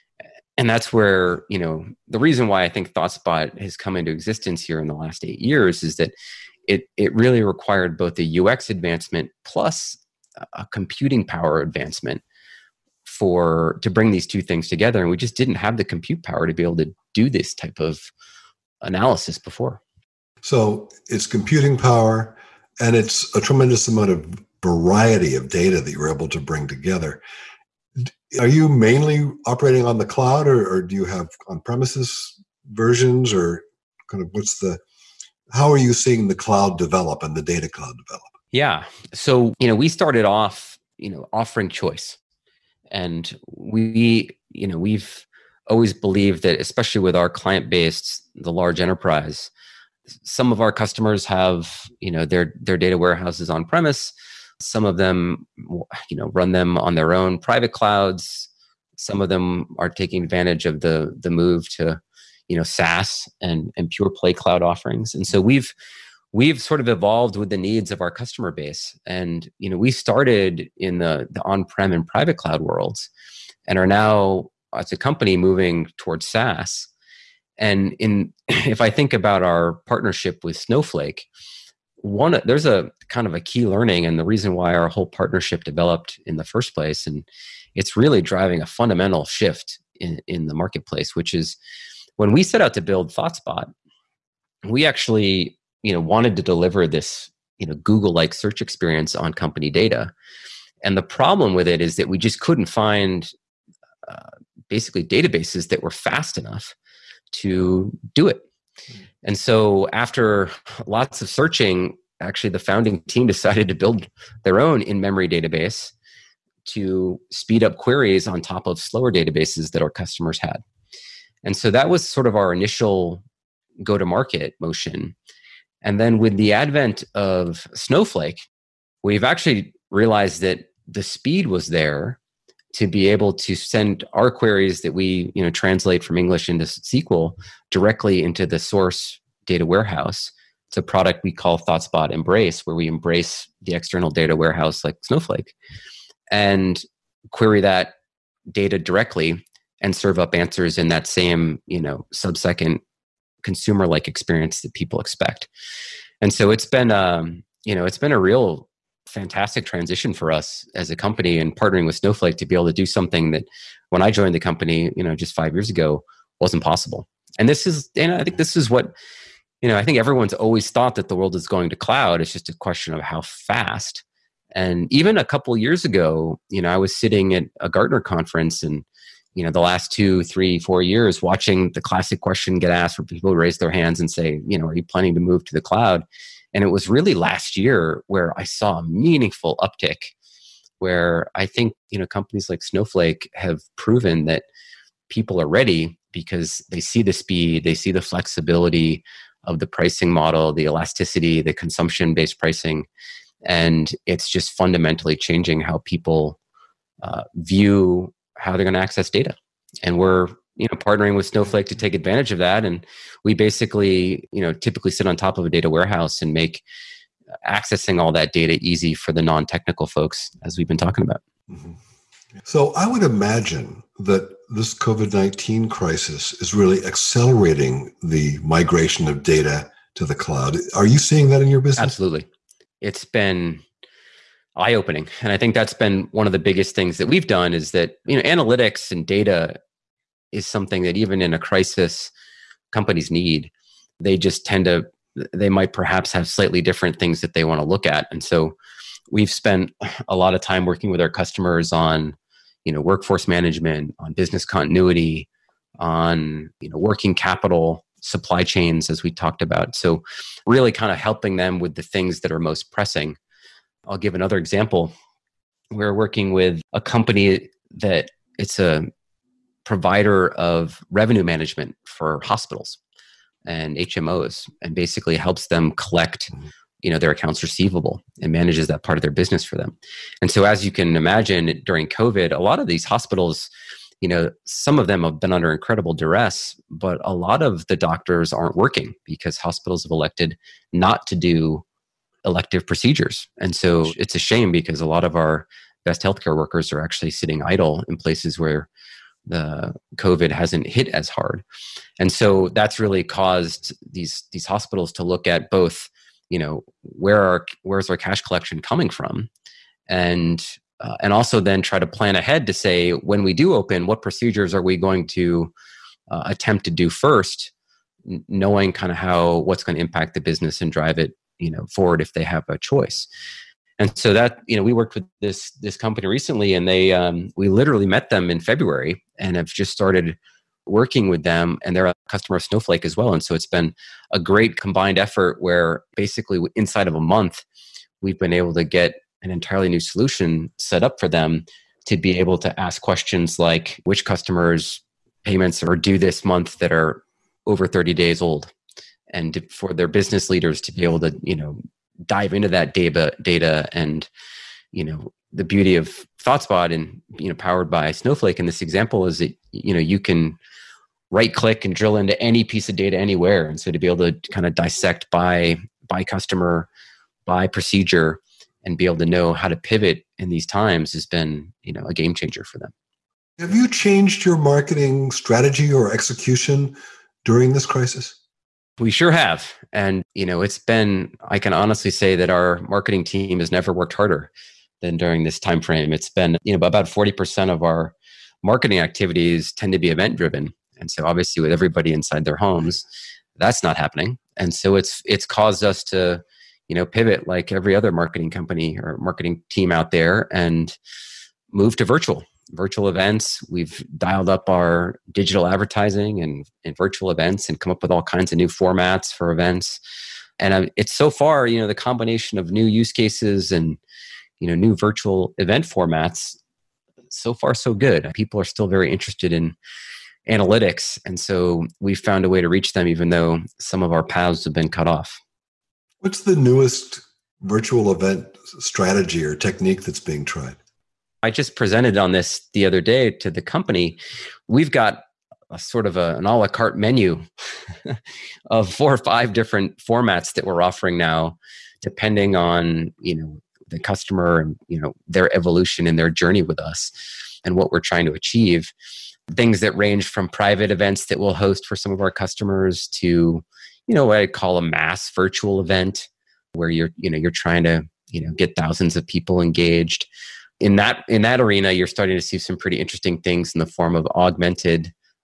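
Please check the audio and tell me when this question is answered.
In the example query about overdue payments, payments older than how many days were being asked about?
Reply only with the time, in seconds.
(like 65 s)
347 s.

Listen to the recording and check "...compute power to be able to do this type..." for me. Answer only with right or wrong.
right.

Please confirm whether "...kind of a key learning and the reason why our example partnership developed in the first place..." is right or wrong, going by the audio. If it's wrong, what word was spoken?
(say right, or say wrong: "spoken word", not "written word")
wrong: "whole", not "example".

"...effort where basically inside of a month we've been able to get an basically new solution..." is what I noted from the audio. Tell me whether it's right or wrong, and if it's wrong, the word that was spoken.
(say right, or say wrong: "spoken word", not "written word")
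wrong: "entirely", not "basically".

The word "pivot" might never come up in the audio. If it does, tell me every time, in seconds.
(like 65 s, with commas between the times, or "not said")
369 s, 396 s.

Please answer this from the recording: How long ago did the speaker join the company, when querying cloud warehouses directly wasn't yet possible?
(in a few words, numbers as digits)
5 years.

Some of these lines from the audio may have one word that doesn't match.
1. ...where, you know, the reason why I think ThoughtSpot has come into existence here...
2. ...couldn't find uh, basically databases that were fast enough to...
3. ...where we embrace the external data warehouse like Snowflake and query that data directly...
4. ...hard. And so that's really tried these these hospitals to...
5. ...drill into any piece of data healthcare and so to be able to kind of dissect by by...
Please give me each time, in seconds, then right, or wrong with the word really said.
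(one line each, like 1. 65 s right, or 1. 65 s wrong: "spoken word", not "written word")
1. 0 s right
2. 102 s right
3. 142 s right
4. 301 s wrong: "caused", not "tried"
5. 361 s wrong: "anywhere", not "healthcare".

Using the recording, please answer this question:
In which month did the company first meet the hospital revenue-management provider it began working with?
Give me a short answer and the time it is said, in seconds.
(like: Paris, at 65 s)
February, at 328 s.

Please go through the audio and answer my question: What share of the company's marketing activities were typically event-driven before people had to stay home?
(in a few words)
40%.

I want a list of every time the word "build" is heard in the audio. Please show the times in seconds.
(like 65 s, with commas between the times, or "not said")
92 s, 113 s.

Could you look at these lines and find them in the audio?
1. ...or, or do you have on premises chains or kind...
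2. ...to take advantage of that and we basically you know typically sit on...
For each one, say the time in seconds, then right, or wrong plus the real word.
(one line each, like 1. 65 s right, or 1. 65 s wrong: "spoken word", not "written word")
1. 30 s wrong: "versions", not "chains"
2. 211 s right.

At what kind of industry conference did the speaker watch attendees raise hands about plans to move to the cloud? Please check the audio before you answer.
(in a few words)
Gartner conference.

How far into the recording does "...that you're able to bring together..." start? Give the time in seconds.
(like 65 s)
25 s.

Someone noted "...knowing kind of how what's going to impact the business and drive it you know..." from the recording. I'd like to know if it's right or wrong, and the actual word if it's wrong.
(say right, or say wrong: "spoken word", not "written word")
right.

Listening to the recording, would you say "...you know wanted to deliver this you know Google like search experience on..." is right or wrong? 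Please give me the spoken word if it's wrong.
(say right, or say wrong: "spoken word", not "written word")
right.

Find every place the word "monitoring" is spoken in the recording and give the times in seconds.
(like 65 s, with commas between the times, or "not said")
not said.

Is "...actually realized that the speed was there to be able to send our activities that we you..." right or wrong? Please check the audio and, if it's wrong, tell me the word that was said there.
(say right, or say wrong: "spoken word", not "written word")
wrong: "queries", not "activities".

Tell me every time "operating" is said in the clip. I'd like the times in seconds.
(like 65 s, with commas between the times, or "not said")
29 s.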